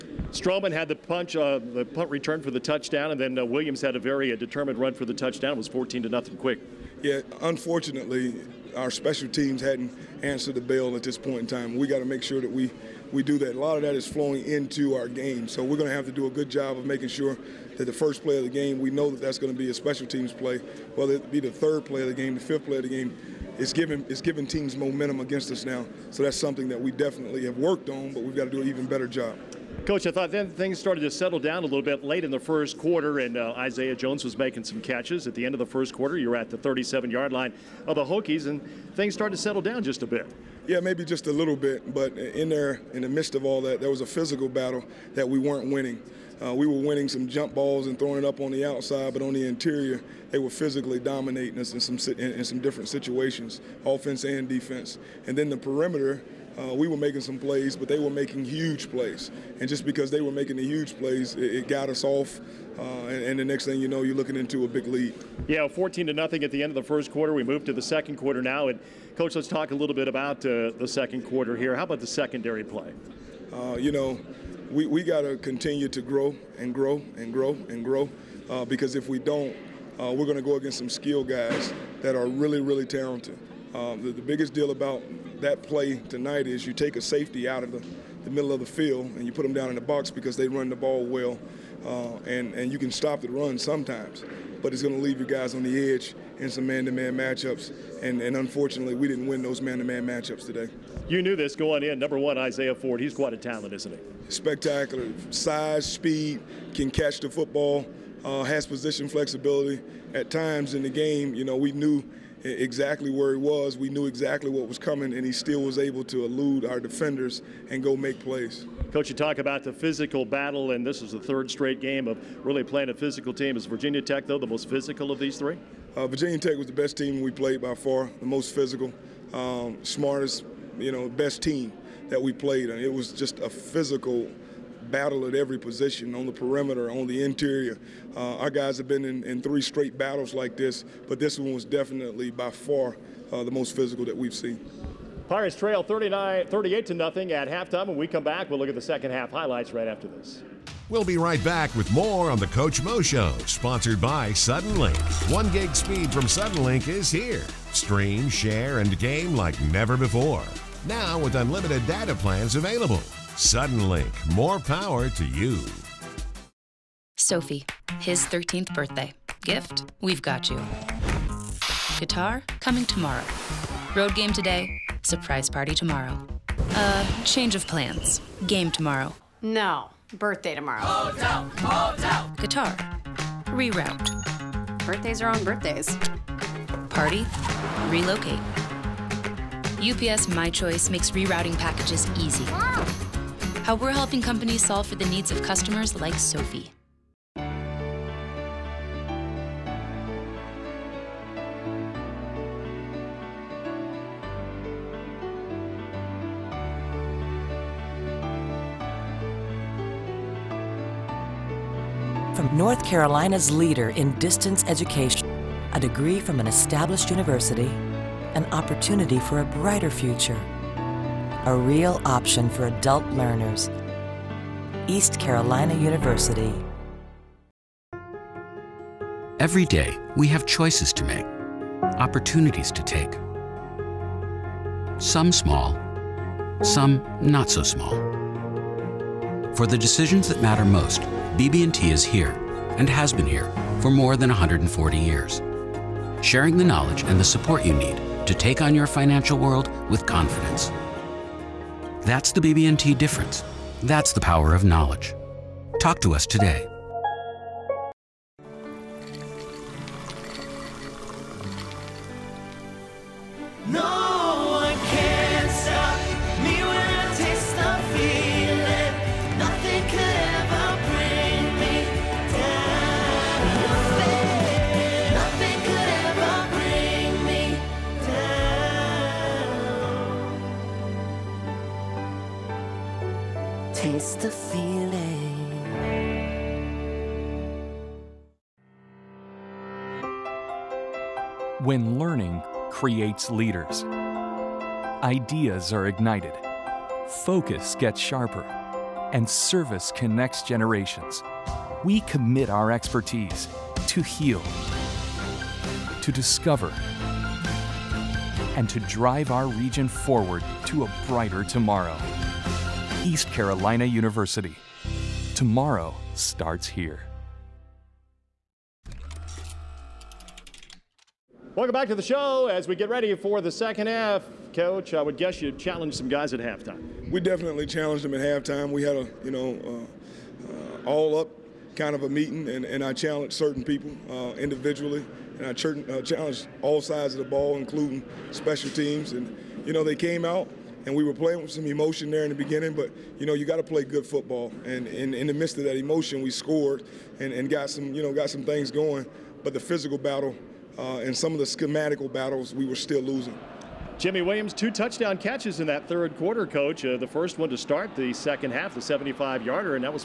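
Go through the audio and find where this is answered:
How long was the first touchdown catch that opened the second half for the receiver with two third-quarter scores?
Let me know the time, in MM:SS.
05:58.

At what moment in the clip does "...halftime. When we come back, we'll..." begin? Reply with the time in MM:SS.
02:27.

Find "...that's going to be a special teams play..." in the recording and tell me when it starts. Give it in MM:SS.
00:19.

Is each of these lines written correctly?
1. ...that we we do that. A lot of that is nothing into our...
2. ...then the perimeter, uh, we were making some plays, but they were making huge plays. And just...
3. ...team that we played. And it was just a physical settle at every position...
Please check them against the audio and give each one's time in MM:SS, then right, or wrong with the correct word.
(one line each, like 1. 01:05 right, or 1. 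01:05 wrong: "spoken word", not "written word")
1. 00:12 wrong: "flowing", not "nothing"
2. 00:55 right
3. 02:11 wrong: "battle", not "settle".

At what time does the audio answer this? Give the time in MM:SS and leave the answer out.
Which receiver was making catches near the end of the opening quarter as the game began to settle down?
00:33.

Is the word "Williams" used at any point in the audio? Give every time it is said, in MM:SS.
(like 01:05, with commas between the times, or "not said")
00:03, 05:54.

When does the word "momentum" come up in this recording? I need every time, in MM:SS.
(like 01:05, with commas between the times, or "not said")
00:24.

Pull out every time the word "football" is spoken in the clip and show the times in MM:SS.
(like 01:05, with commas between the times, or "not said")
01:47, 05:44.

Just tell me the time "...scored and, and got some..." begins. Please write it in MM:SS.
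05:46.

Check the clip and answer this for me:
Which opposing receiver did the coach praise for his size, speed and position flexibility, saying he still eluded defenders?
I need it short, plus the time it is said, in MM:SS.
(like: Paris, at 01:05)
Isaiah Ford, at 01:42.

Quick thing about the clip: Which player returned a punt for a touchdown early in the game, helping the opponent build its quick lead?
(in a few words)
Stroman.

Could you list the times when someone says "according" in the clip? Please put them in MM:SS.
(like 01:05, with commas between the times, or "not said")
not said.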